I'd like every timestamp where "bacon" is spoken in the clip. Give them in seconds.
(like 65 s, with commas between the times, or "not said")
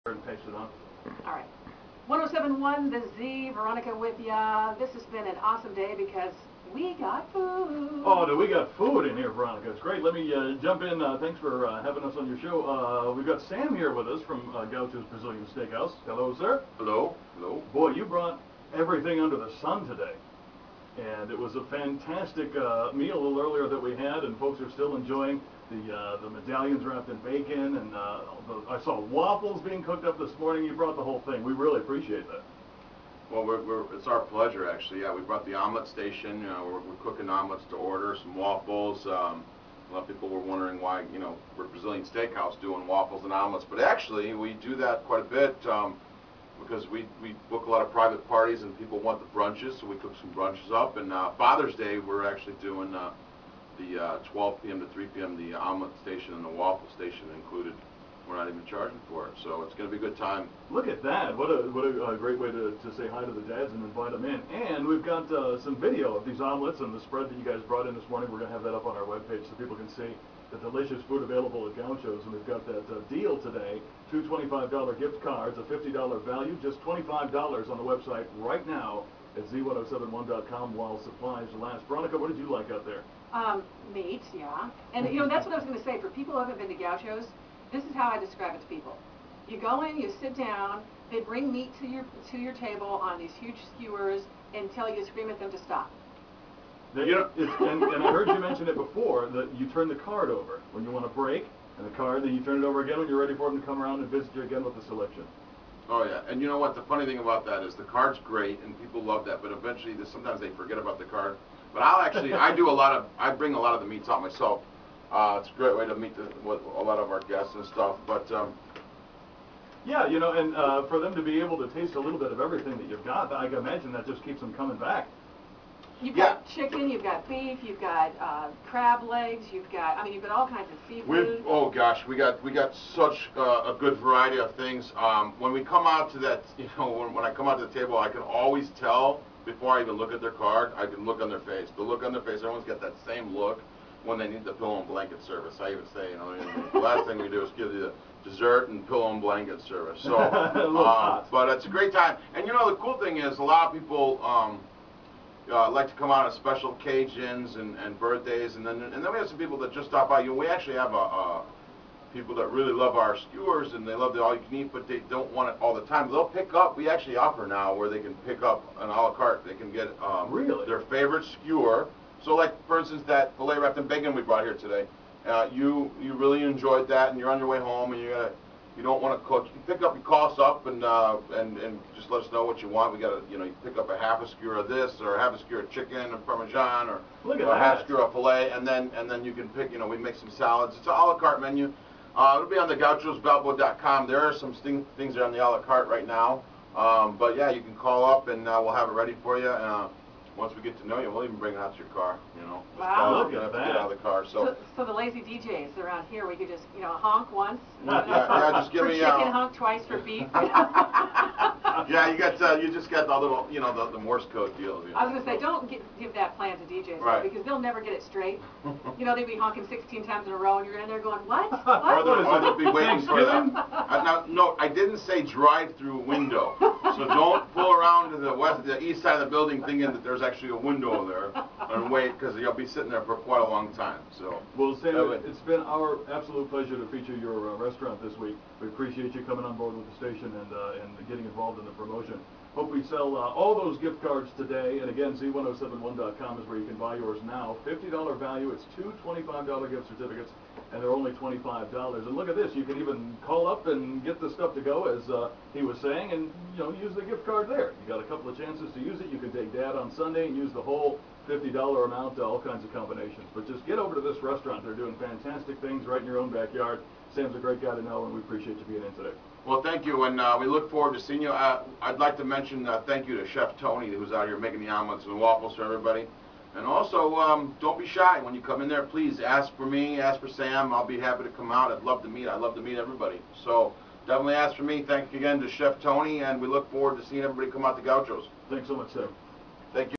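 27 s, 173 s.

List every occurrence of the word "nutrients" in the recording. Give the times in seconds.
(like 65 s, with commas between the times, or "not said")
not said.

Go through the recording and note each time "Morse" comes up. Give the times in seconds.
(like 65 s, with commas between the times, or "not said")
213 s.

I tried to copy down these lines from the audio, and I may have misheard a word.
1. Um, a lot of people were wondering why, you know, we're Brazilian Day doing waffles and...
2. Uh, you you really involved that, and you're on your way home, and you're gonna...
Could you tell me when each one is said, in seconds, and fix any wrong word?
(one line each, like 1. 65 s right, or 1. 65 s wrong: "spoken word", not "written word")
1. 39 s wrong: "Steakhouse", not "Day"
2. 175 s wrong: "enjoyed", not "involved".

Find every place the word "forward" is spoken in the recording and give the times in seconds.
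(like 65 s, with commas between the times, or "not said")
270 s, 286 s.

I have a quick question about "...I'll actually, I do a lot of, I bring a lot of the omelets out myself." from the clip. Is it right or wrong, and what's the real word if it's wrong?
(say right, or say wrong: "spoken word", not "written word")
wrong: "meats", not "omelets".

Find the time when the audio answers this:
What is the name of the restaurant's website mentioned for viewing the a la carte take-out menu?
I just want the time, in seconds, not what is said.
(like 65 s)
192 s.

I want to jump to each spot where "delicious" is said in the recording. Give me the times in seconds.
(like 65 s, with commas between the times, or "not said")
70 s.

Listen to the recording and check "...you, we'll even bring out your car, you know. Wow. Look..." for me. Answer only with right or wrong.
right.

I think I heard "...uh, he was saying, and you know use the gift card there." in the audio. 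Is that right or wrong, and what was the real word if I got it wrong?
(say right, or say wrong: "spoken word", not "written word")
right.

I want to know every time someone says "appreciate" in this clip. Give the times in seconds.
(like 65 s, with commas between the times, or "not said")
31 s, 238 s, 268 s.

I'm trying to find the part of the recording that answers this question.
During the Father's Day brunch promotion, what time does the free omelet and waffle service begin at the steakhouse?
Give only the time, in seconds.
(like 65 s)
54 s.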